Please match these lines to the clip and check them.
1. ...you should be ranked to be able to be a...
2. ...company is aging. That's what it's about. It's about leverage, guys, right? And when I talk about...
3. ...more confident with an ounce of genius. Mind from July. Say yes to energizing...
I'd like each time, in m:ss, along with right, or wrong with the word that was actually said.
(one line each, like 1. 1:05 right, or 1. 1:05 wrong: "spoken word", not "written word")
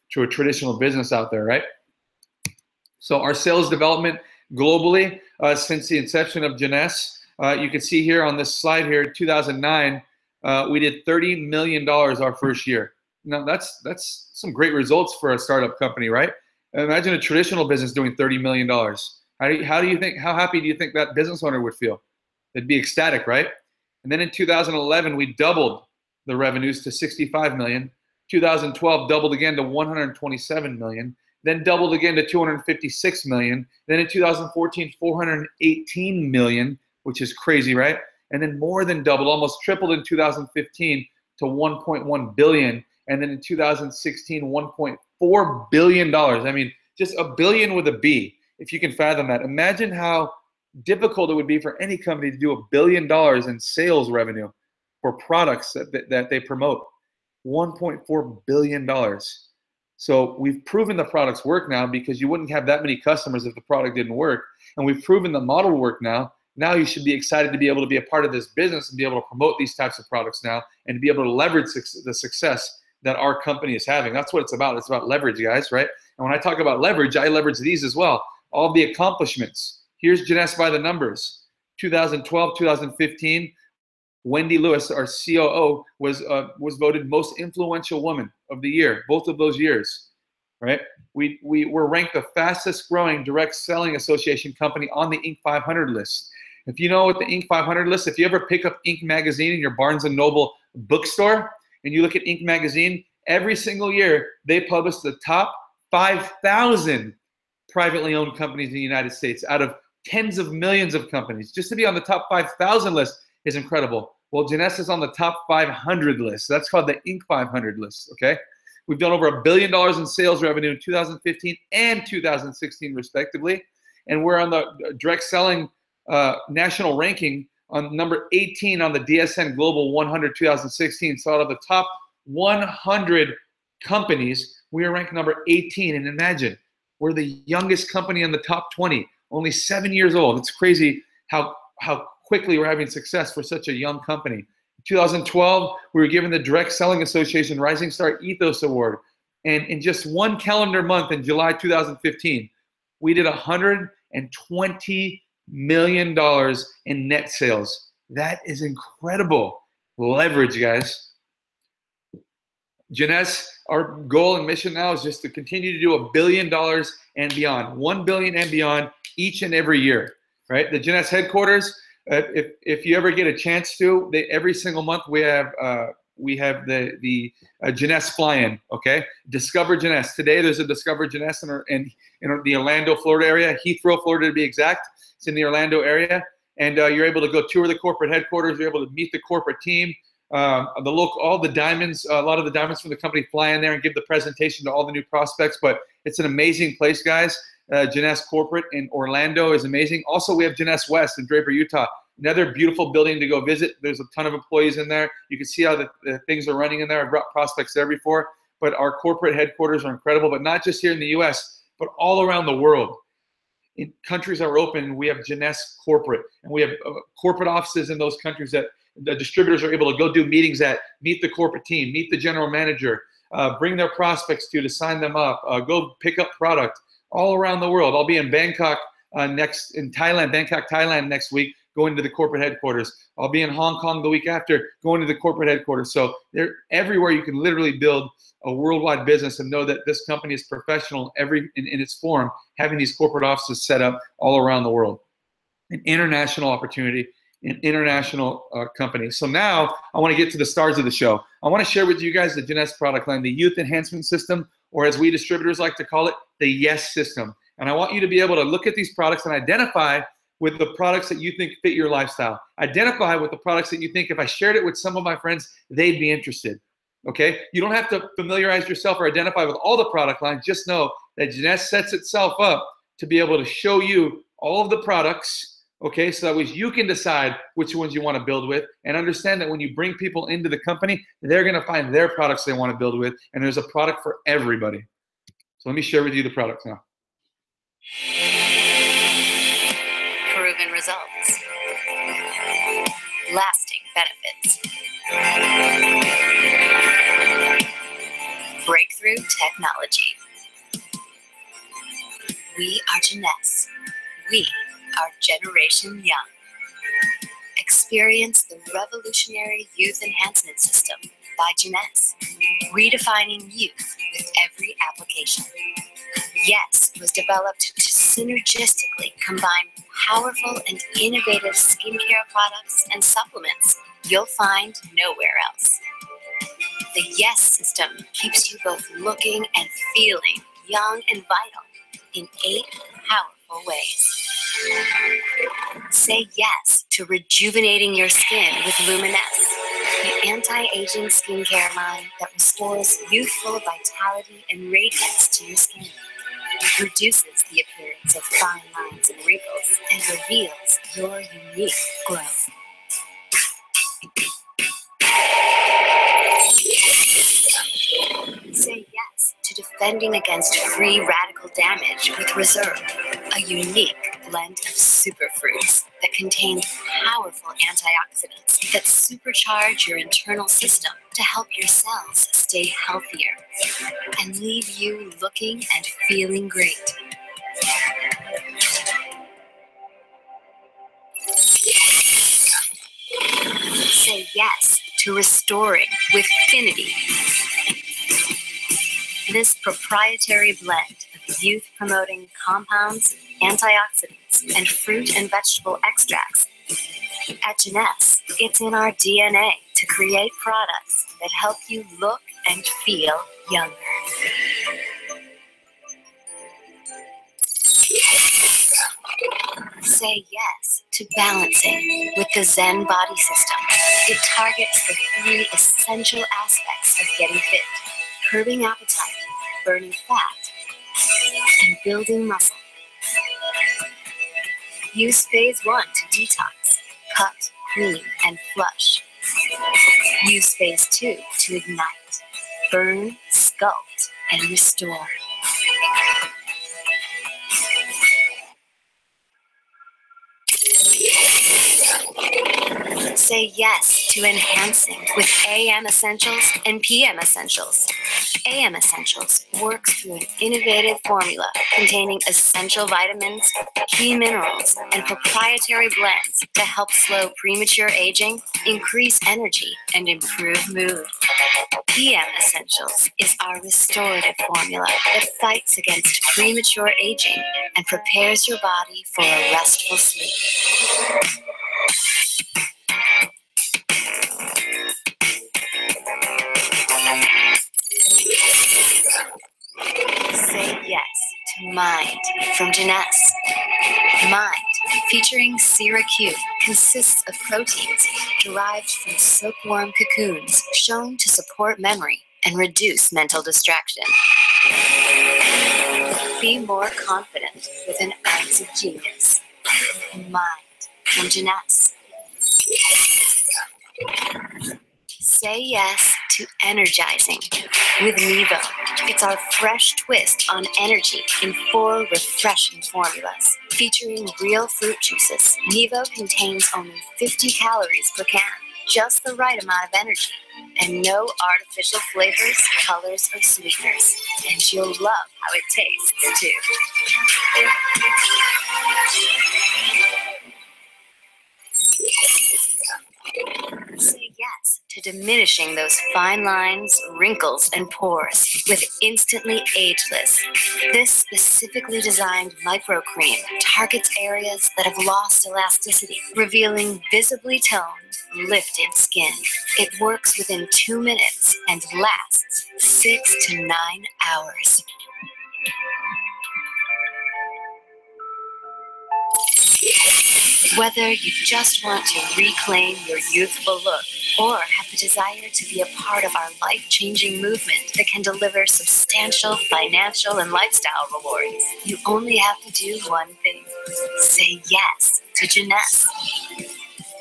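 1. 1:06 wrong: "excited", not "ranked"
2. 1:13 wrong: "having", not "aging"
3. 8:16 wrong: "Jeunesse", not "July".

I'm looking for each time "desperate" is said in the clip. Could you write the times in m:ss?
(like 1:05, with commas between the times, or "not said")
not said.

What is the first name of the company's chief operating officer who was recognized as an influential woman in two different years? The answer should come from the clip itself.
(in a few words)
Wendy.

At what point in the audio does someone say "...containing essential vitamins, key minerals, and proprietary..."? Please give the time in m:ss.
7:31.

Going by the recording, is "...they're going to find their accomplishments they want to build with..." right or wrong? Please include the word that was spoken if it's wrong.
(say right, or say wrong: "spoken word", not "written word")
wrong: "products", not "accomplishments".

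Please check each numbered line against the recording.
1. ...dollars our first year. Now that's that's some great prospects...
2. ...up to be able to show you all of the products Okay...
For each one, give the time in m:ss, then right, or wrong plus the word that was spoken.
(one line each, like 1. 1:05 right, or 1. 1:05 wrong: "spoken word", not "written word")
1. 0:11 wrong: "results", not "prospects"
2. 4:32 right.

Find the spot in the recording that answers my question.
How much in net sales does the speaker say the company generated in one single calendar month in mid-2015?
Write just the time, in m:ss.
2:33.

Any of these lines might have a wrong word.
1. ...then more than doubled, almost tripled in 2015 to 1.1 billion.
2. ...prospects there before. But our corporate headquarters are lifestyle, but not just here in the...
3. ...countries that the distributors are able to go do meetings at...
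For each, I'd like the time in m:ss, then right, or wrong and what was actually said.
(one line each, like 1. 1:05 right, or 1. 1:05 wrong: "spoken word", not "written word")
1. 0:38 right
2. 3:27 wrong: "incredible", not "lifestyle"
3. 3:38 right.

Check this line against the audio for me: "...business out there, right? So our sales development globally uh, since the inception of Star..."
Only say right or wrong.
wrong.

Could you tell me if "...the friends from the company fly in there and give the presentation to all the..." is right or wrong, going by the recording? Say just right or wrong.
wrong.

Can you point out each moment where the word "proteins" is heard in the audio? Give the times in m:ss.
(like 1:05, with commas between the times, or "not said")
8:07.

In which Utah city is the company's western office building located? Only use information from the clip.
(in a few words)
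Draper.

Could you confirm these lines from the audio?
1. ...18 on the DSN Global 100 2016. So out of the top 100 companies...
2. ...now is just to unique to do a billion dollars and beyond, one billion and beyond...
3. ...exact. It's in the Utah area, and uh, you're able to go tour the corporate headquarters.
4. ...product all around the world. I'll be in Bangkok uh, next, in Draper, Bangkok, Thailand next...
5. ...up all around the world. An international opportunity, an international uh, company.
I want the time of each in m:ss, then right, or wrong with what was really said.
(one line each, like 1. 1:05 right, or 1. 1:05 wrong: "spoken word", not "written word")
1. 2:08 right
2. 2:44 wrong: "continue", not "unique"
3. 3:04 wrong: "Orlando", not "Utah"
4. 3:46 wrong: "Thailand", not "Draper"
5. 4:03 right.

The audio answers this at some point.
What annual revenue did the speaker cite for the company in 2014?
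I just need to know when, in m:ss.
0:34.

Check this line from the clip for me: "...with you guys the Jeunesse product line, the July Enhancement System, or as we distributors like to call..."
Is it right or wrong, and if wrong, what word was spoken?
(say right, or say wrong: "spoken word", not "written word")
wrong: "Youth", not "July".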